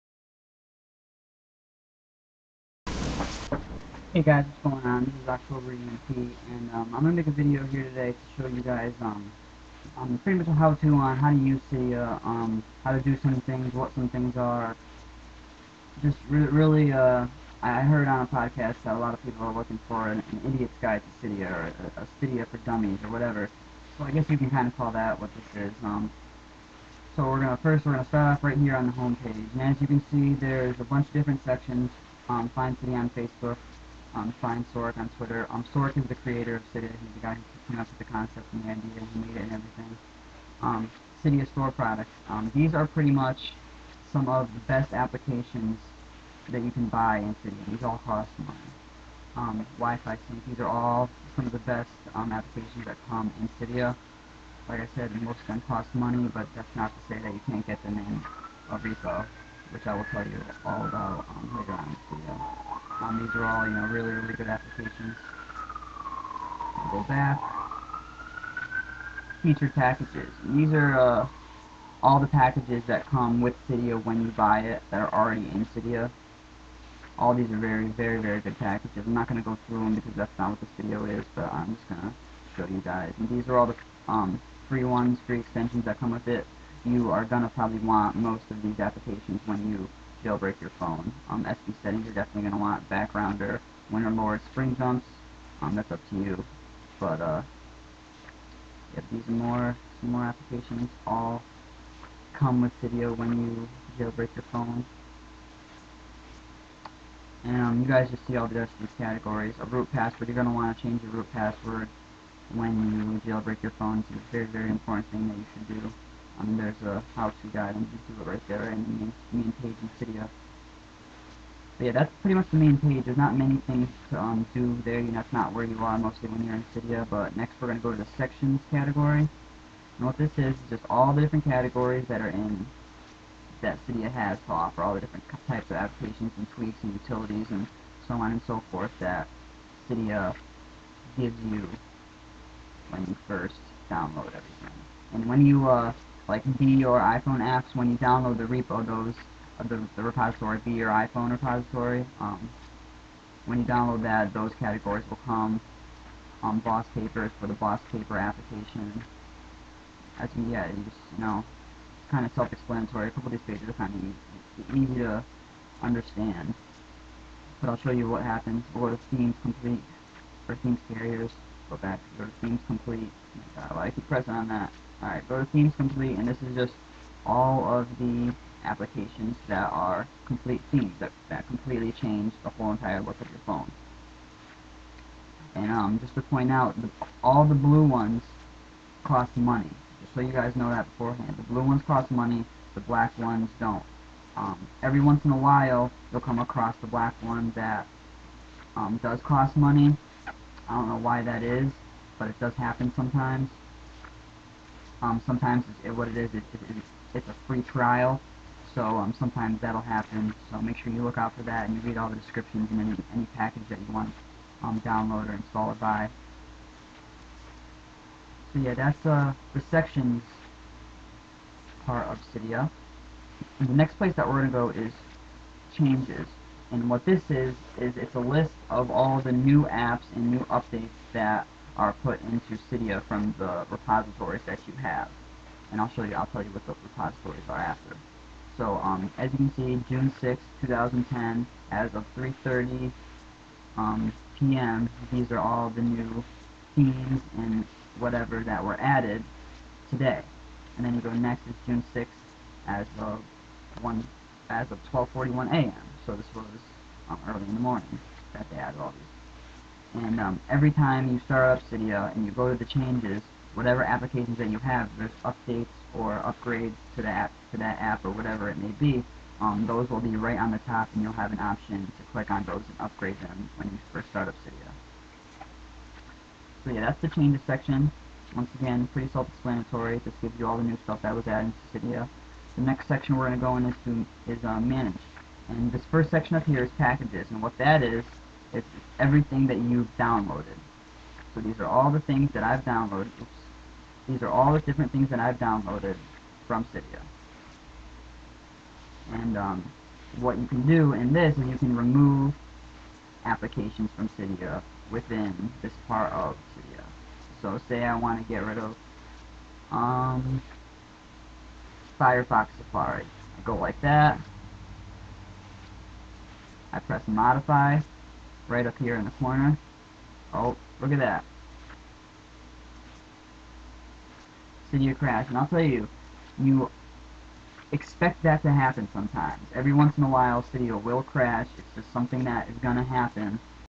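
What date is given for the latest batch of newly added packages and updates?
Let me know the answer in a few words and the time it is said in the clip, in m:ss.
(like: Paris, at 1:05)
June 6, 2010, at 3:59.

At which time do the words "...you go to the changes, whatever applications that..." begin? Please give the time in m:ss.
4:22.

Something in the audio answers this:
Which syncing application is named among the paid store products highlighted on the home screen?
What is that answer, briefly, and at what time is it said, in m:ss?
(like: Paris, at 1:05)
Wi-Fi sync, at 0:49.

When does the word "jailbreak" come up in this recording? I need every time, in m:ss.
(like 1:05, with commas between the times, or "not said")
1:30, 1:43, 1:53.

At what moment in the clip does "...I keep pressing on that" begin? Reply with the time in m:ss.
2:53.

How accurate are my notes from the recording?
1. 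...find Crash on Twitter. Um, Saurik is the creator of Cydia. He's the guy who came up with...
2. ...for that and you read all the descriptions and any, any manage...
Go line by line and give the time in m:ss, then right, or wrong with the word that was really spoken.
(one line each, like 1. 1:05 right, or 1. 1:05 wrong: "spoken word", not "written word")
1. 0:34 wrong: "Saurik", not "Crash"
2. 3:31 wrong: "package", not "manage".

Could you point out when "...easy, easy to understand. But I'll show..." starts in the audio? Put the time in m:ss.
2:44.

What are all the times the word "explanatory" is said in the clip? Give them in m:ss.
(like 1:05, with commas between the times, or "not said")
2:42, 4:39.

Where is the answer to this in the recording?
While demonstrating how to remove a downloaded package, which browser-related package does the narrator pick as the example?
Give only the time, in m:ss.
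5:11.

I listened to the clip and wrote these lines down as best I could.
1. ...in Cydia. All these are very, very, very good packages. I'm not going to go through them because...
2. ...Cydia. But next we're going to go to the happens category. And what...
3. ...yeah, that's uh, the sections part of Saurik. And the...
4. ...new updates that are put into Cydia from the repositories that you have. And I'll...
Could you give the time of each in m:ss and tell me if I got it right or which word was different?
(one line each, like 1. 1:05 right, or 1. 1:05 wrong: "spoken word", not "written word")
1. 1:15 right
2. 2:06 wrong: "sections", not "happens"
3. 3:38 wrong: "Cydia", not "Saurik"
4. 3:50 right.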